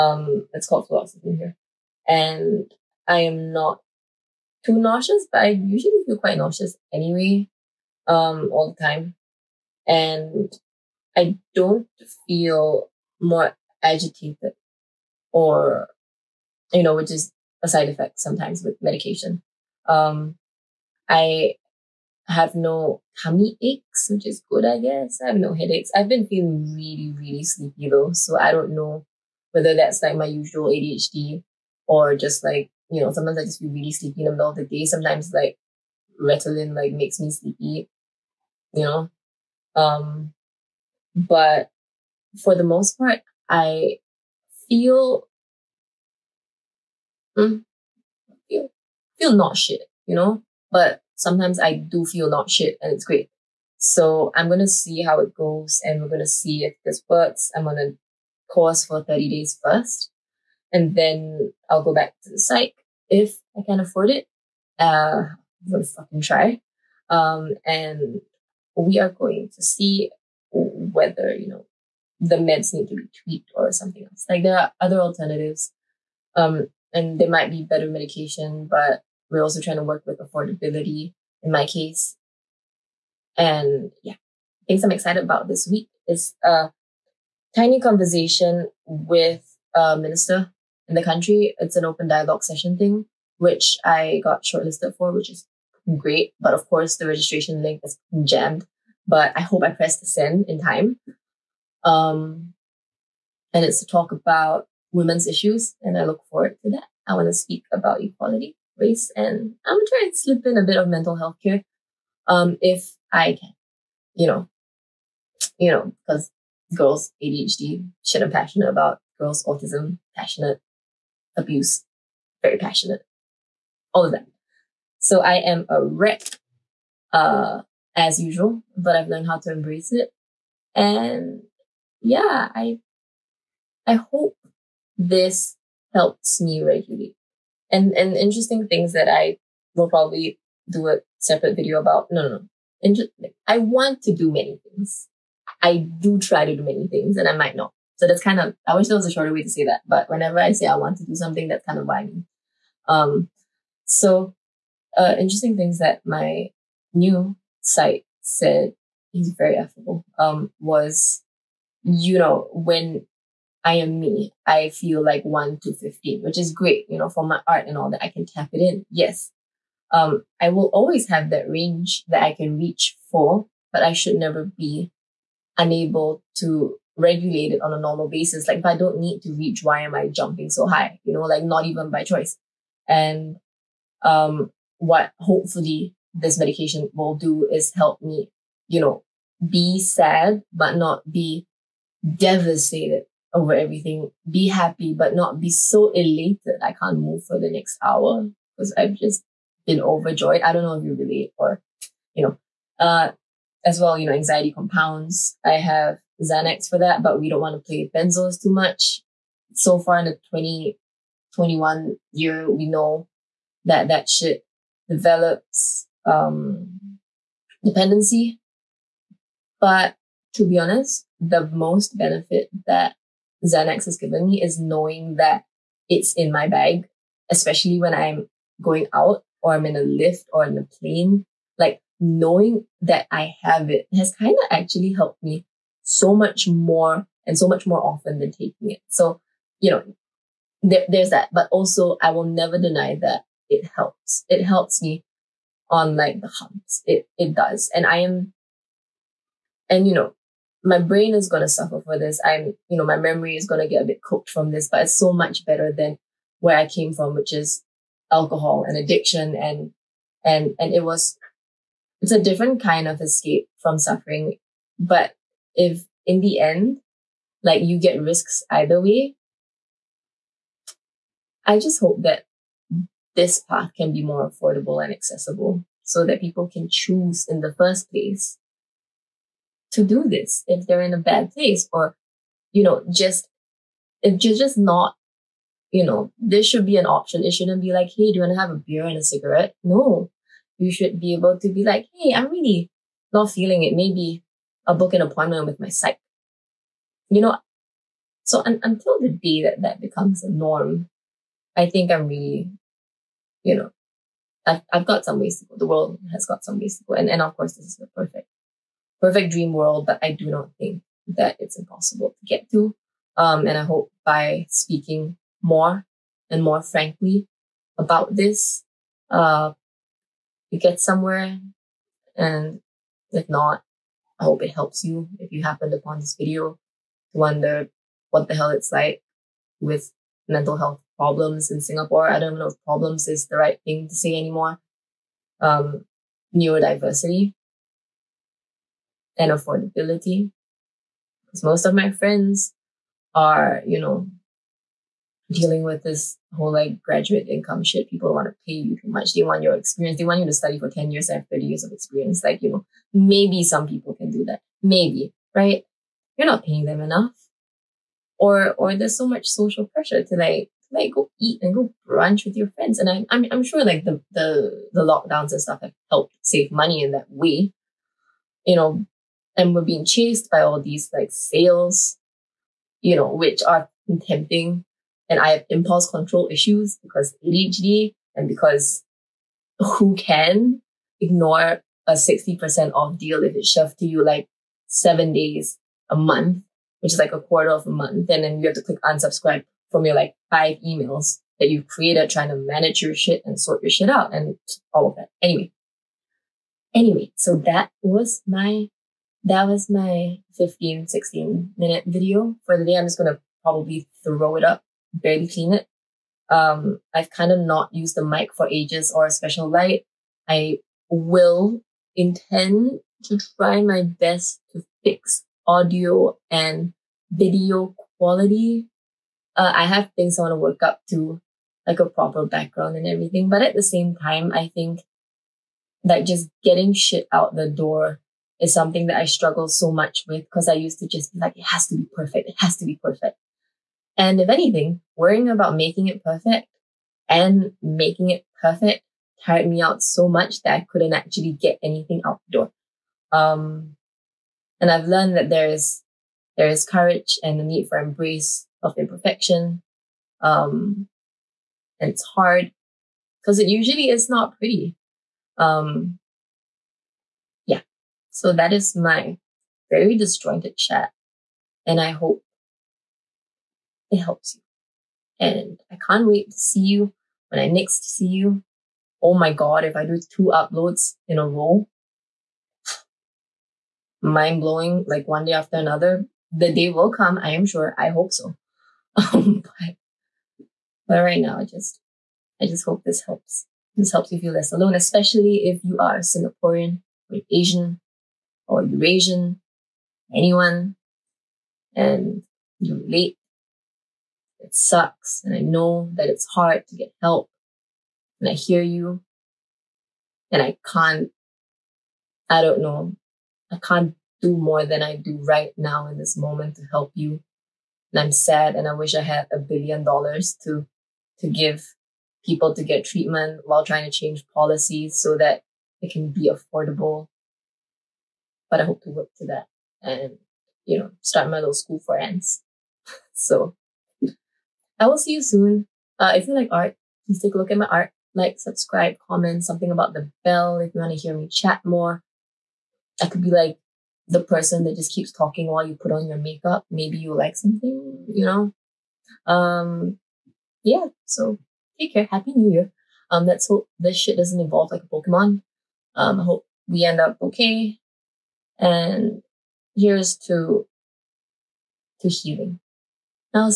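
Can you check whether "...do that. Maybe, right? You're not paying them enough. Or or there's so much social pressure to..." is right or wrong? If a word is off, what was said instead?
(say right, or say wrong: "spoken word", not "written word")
right.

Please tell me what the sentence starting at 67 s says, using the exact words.
Um, and we are going to see whether you know the meds need to be tweaked or something else.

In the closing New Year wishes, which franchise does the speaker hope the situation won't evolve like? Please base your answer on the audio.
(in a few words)
Pokemon.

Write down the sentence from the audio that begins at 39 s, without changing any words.
Um, but for the most part, I feel hmm, feel feel not shit, you know.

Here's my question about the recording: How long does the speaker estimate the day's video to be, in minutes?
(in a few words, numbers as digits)
15, 16 minutes.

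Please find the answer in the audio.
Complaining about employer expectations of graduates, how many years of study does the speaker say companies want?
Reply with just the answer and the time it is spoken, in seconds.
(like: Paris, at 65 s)
10 years, at 350 s.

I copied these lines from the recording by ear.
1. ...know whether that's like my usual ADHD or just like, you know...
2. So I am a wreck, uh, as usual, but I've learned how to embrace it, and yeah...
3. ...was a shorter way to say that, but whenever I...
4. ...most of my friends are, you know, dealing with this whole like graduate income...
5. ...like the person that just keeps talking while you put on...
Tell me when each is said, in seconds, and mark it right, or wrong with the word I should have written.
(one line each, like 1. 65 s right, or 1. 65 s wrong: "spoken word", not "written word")
1. 28 s right
2. 124 s right
3. 148 s right
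4. 341 s right
5. 533 s right.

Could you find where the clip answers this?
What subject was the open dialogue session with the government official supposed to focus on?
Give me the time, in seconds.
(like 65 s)
104 s.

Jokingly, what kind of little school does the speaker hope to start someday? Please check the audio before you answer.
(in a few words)
school for ants.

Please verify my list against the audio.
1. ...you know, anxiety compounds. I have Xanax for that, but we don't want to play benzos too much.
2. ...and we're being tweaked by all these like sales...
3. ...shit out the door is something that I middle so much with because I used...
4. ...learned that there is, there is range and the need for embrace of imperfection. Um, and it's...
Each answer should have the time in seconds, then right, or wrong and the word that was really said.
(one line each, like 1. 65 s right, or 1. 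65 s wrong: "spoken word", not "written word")
1. 203 s right
2. 369 s wrong: "chased", not "tweaked"
3. 426 s wrong: "struggle", not "middle"
4. 444 s wrong: "courage", not "range".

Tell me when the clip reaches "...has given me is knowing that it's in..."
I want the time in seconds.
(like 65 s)
223 s.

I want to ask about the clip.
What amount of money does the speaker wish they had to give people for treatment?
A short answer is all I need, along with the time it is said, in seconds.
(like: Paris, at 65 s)
a billion dollars, at 509 s.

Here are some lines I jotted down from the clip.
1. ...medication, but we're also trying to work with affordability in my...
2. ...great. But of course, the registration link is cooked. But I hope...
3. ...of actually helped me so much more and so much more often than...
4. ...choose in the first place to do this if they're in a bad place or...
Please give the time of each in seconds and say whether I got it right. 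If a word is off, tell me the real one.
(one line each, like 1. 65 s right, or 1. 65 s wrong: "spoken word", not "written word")
1. 77 s right
2. 95 s wrong: "jammed", not "cooked"
3. 234 s right
4. 276 s right.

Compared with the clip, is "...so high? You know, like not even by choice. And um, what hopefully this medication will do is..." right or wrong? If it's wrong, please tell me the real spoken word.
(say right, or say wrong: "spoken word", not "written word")
right.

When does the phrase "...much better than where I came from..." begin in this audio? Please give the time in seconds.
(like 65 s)
255 s.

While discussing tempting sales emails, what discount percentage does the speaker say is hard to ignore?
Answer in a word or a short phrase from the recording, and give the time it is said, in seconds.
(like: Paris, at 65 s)
60%, at 381 s.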